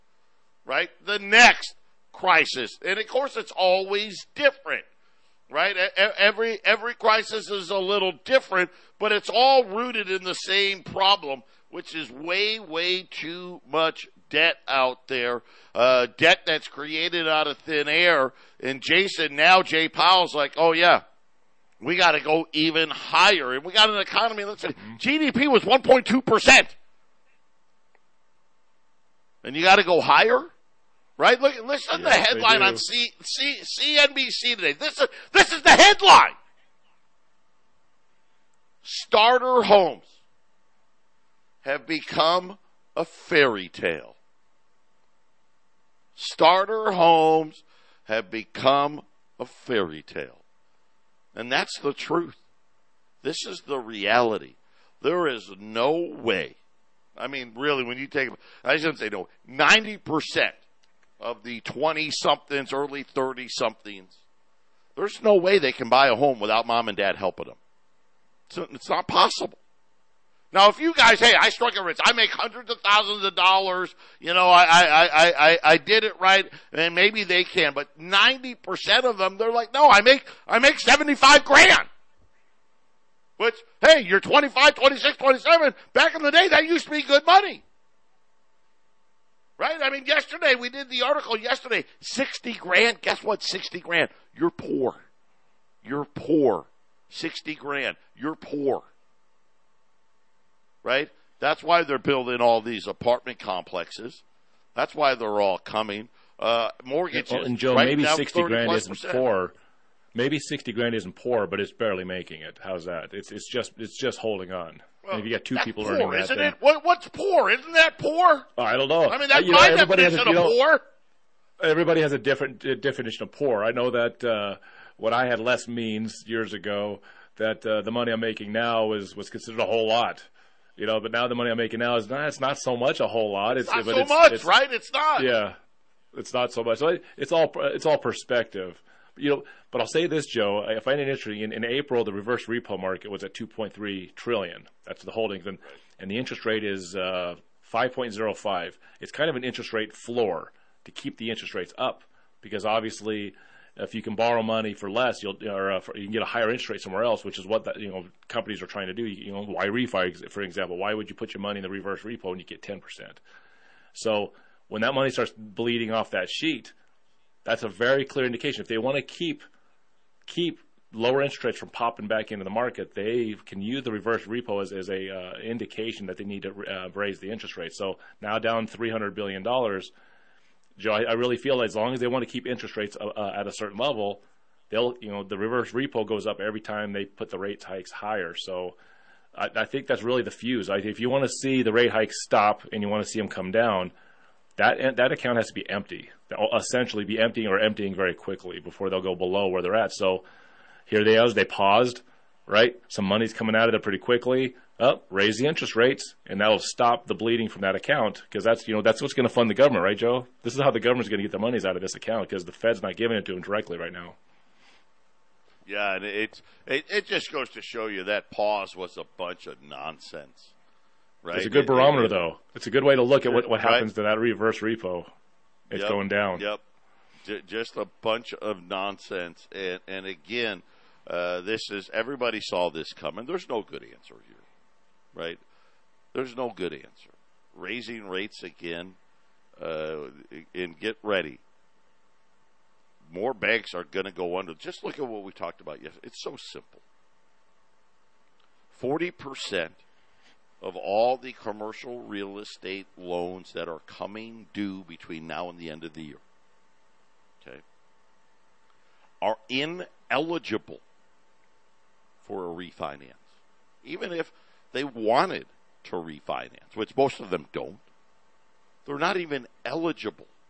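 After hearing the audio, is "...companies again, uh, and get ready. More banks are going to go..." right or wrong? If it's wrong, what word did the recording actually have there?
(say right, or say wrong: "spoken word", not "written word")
wrong: "rates", not "companies".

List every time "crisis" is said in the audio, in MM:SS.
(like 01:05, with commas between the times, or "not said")
00:02, 00:06.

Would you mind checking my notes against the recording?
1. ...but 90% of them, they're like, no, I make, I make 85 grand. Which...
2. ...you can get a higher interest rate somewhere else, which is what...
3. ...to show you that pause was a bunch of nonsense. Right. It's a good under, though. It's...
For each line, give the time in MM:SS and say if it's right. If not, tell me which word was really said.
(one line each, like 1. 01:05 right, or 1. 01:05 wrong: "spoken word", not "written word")
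1. 01:17 wrong: "75", not "85"
2. 02:35 right
3. 03:37 wrong: "barometer", not "under".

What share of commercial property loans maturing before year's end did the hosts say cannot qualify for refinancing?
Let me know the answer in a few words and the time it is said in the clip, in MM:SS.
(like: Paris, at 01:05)
40%, at 04:08.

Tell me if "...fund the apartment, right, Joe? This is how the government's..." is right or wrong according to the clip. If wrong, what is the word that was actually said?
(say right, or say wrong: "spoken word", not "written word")
wrong: "government", not "apartment".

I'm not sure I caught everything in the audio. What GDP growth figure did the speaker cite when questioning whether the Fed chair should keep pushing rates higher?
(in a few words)
1.2%.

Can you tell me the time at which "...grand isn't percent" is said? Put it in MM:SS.
01:48.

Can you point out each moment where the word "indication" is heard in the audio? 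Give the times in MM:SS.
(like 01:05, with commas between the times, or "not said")
02:48, 02:55.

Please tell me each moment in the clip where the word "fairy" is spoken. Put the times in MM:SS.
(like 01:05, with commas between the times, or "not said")
00:43, 00:49.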